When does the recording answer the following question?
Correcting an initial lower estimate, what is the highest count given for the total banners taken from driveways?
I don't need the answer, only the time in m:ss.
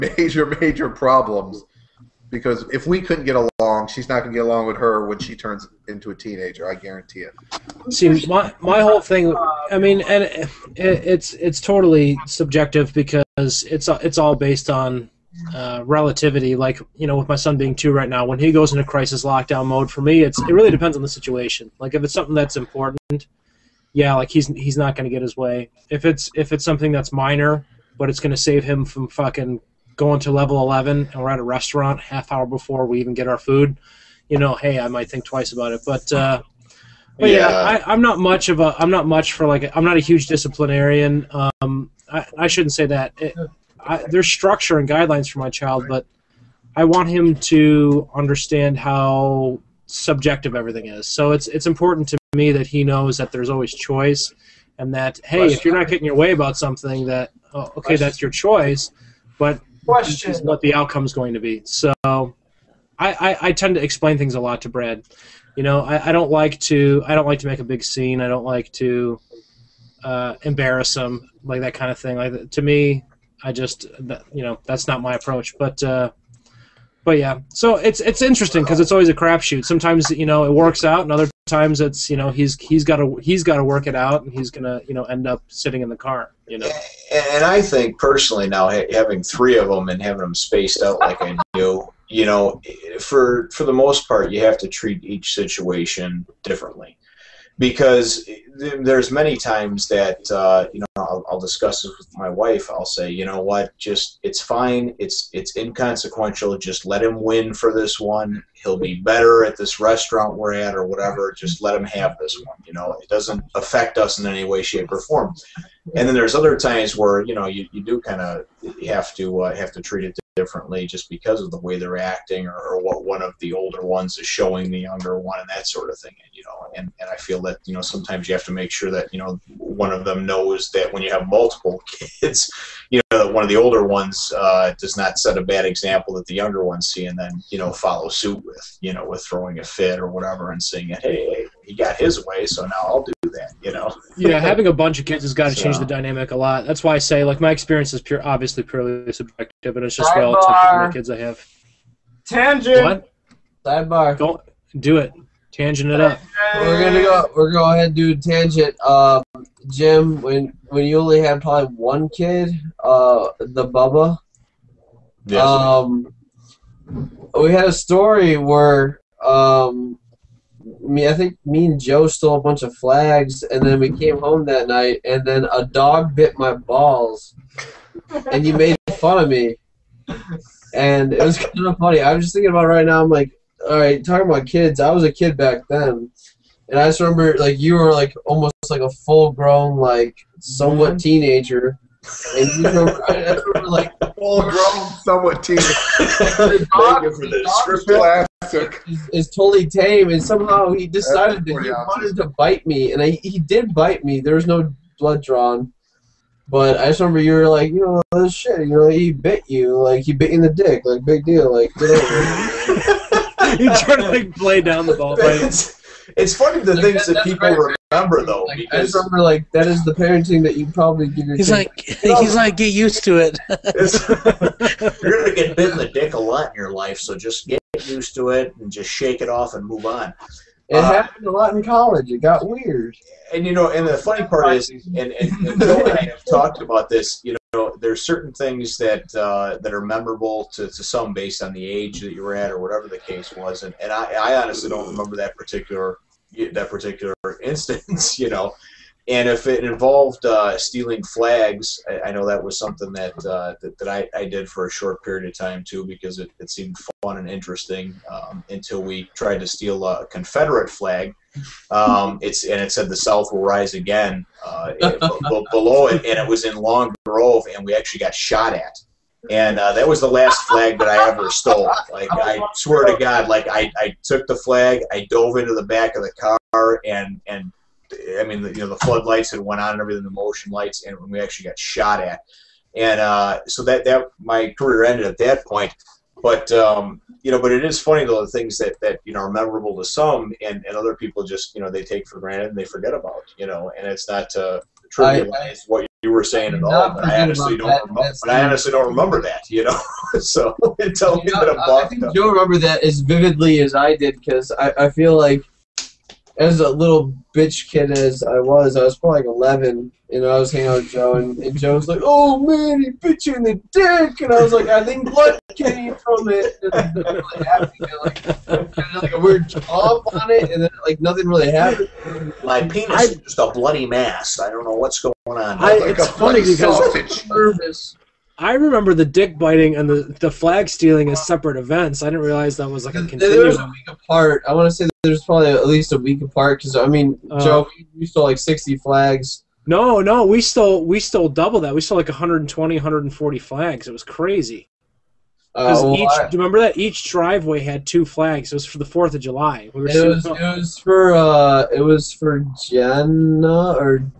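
5:42.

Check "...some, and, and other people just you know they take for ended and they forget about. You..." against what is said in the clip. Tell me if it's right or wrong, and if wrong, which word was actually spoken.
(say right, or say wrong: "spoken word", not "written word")
wrong: "granted", not "ended".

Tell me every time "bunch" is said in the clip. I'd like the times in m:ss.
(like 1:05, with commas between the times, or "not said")
2:24, 2:52.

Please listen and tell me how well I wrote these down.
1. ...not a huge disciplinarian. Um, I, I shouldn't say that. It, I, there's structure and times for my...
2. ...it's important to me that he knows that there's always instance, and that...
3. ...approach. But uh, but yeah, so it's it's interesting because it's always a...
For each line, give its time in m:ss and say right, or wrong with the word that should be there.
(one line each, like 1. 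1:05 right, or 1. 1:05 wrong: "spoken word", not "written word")
1. 0:39 wrong: "guidelines", not "times"
2. 0:51 wrong: "choice", not "instance"
3. 1:15 right.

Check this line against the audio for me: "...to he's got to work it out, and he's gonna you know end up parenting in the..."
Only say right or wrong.
wrong.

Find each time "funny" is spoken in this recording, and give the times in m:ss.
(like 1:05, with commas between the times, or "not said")
3:01, 3:36, 3:53, 4:47, 5:26.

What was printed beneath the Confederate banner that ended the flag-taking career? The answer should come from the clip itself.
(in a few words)
The South will rise again.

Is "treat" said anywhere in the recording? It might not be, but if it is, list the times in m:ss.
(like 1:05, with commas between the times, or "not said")
1:34, 1:59.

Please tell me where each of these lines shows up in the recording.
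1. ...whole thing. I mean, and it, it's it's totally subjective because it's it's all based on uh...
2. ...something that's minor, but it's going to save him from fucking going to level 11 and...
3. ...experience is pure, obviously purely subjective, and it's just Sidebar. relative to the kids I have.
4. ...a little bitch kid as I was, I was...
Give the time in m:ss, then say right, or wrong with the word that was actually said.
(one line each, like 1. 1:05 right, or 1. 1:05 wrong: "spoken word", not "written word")
1. 0:08 right
2. 0:26 right
3. 2:27 right
4. 5:06 right.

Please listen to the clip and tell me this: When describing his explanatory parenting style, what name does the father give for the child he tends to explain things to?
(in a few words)
Brad.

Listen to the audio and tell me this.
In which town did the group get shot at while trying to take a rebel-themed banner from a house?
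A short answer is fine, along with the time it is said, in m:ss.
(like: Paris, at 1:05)
Long Grove, at 4:26.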